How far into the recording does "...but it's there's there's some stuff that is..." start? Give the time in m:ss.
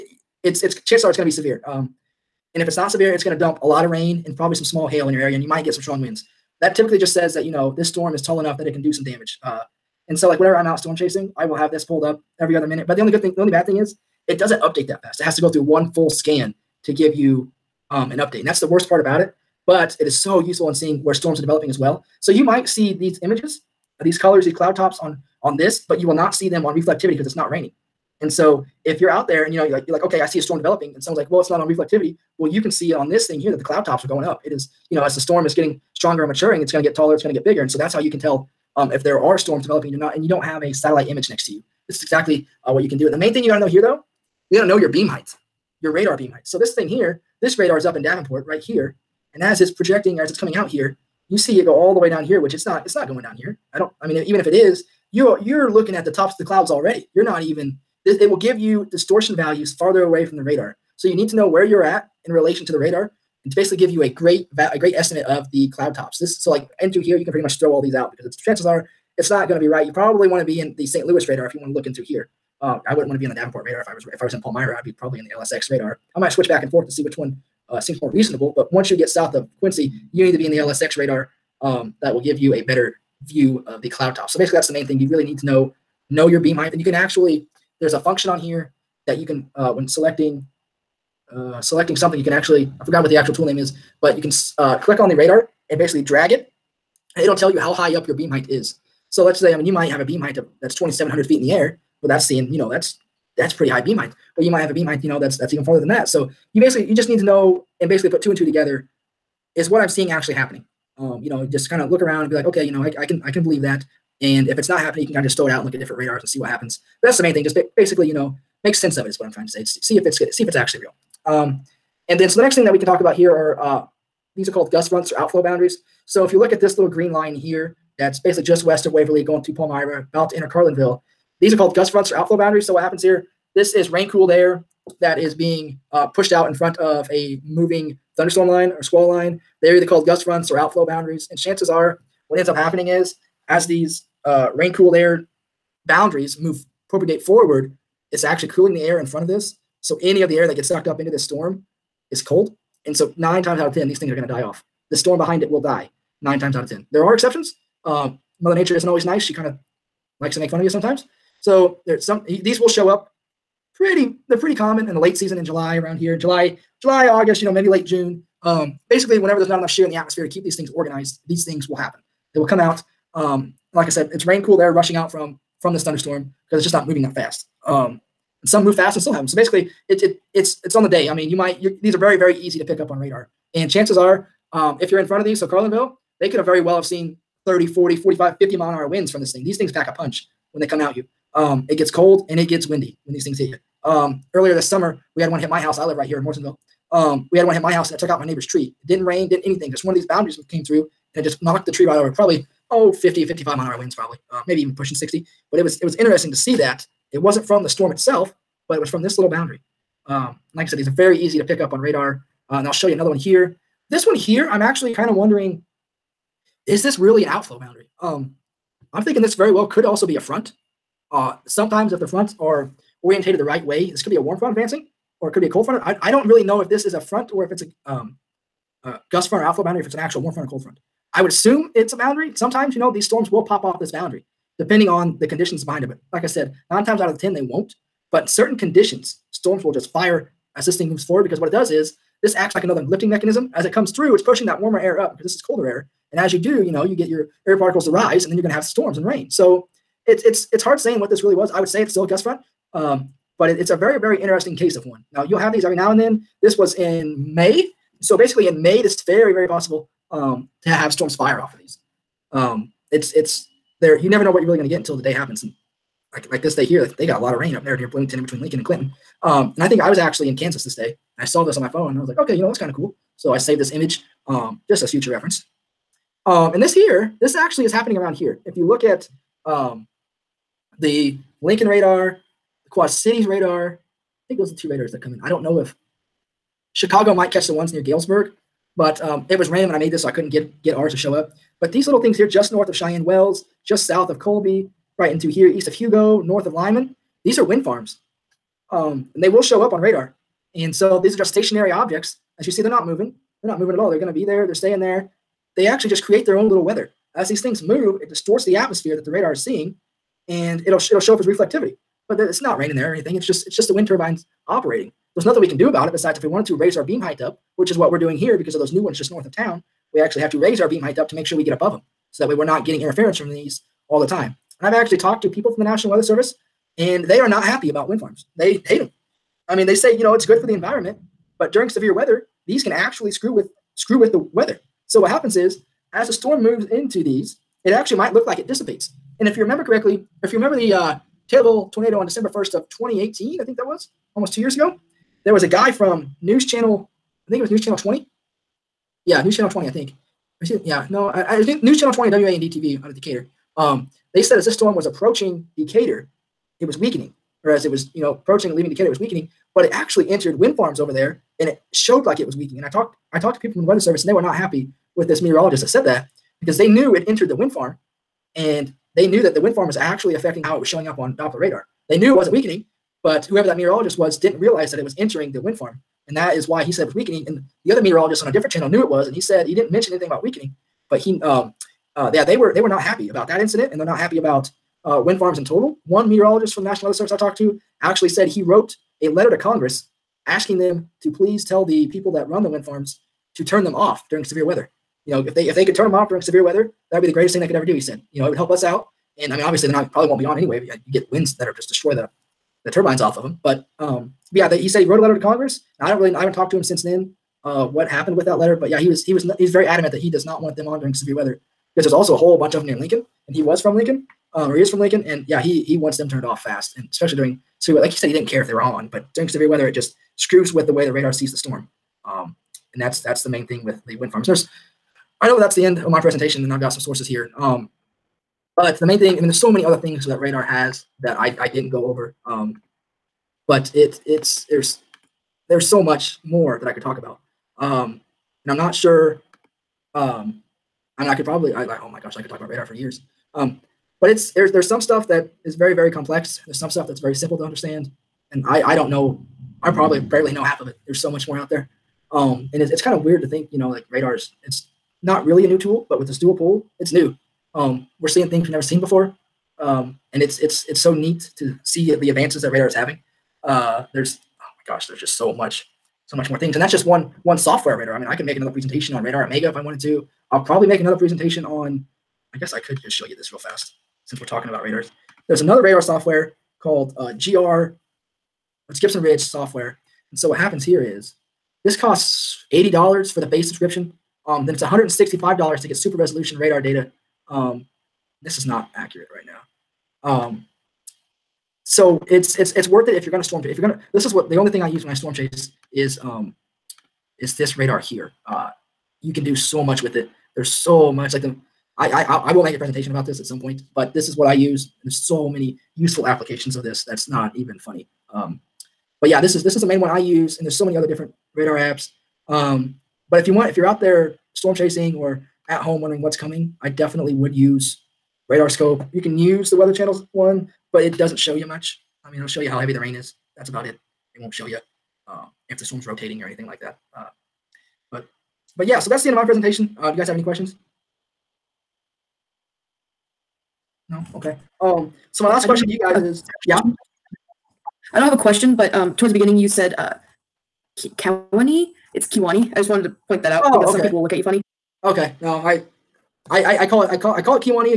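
7:24.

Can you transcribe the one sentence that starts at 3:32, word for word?
Uh, and I'll show you another one here.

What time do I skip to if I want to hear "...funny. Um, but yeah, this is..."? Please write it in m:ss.
8:27.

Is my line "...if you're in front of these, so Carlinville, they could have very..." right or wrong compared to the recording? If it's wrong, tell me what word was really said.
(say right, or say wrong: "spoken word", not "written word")
right.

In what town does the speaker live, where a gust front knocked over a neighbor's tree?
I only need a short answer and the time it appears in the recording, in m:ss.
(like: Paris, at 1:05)
Morrisonville, at 3:16.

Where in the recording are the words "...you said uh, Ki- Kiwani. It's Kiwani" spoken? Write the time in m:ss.
8:59.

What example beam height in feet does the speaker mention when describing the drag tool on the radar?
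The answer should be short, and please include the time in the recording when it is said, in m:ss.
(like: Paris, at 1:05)
2,700 feet, at 1:40.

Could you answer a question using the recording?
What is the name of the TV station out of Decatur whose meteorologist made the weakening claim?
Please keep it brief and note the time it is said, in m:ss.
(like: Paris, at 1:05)
WAND TV, at 5:52.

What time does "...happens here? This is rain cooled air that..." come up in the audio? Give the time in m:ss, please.
2:12.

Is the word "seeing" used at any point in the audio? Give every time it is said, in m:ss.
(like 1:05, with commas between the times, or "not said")
0:20, 1:42, 1:49, 5:09, 7:38.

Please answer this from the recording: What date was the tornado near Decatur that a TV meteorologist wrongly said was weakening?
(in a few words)
December 1st, 2018.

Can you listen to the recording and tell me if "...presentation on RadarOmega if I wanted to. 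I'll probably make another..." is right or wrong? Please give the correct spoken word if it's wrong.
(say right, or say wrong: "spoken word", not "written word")
right.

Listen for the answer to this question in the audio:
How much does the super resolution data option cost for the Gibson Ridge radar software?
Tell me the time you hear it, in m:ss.
8:04.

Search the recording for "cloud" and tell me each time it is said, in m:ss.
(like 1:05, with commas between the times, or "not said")
0:24, 0:33, 0:56, 1:05, 1:23.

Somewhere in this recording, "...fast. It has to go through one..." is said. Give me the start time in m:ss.
0:15.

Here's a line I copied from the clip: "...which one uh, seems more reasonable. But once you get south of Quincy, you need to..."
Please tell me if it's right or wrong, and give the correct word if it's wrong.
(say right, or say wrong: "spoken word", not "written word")
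right.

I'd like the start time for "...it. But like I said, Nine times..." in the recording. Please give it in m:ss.
3:55.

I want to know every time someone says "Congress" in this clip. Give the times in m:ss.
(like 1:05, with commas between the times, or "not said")
6:29, 6:45.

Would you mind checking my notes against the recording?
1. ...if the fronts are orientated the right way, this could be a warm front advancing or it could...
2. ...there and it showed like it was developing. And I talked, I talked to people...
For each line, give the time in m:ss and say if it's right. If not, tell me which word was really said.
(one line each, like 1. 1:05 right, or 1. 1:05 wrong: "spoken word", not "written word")
1. 3:41 right
2. 6:00 wrong: "weakening", not "developing".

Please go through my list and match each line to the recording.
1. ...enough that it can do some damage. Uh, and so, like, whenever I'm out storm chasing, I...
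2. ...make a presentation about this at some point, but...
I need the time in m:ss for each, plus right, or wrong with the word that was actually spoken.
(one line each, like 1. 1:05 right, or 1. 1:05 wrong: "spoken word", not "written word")
1. 0:08 right
2. 8:22 right.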